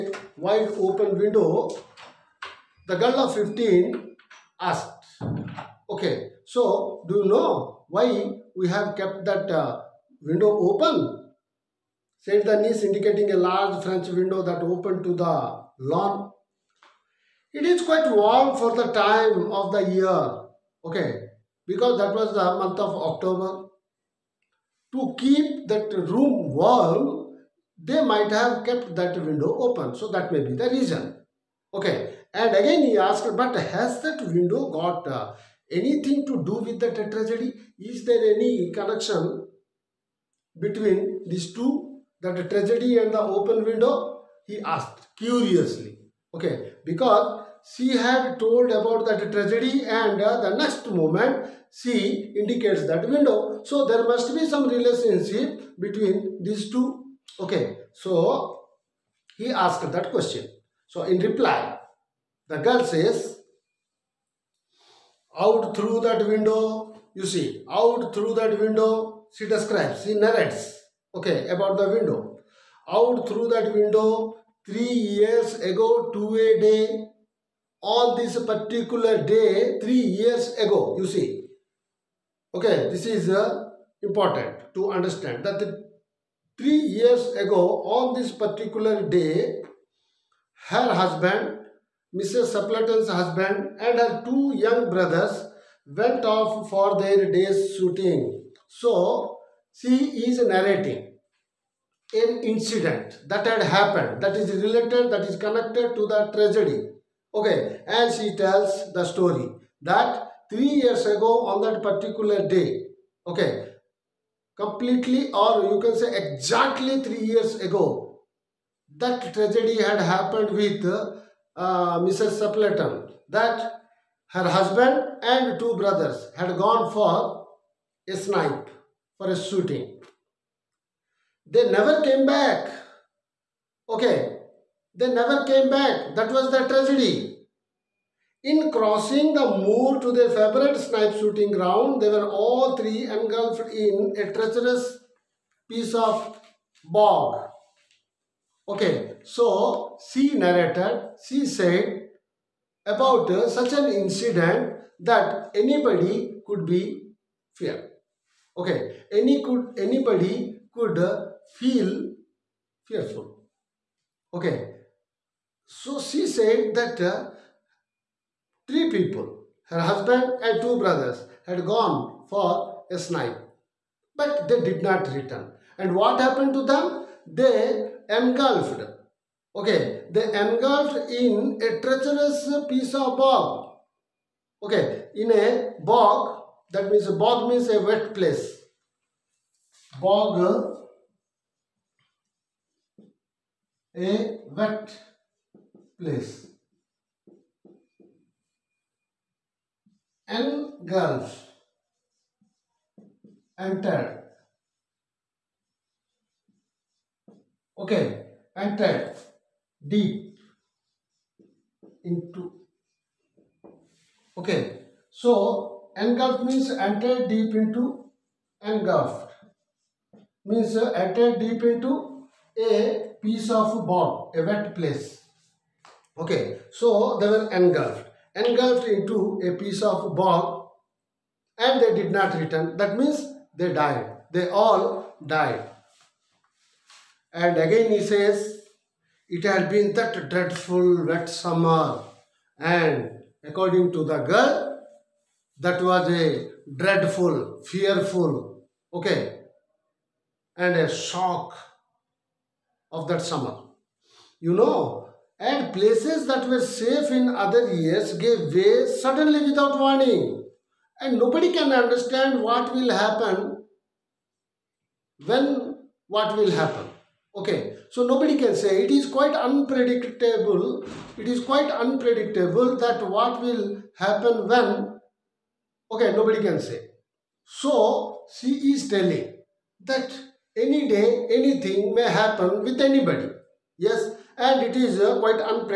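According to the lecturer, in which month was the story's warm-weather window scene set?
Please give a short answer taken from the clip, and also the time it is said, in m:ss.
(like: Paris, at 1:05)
October, at 0:23.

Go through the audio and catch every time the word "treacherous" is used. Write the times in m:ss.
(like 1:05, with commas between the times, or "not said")
2:24, 3:01.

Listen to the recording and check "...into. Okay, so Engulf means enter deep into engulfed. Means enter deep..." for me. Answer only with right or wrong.
right.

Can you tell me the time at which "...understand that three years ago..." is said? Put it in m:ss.
1:24.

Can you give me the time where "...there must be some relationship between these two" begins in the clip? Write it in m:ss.
0:53.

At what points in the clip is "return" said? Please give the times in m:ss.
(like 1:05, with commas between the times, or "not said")
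2:55, 3:52.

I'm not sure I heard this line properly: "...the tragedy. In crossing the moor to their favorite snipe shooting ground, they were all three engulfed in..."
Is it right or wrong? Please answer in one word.
right.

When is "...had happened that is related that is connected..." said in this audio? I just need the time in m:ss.
1:43.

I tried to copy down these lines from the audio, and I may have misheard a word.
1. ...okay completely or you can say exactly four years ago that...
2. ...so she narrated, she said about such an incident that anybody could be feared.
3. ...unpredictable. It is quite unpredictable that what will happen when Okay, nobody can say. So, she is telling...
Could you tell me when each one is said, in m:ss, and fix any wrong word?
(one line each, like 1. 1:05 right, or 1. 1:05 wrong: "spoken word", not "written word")
1. 1:53 wrong: "three", not "four"
2. 2:29 right
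3. 4:29 right.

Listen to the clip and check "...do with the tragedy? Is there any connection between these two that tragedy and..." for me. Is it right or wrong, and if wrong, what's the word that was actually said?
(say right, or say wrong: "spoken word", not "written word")
right.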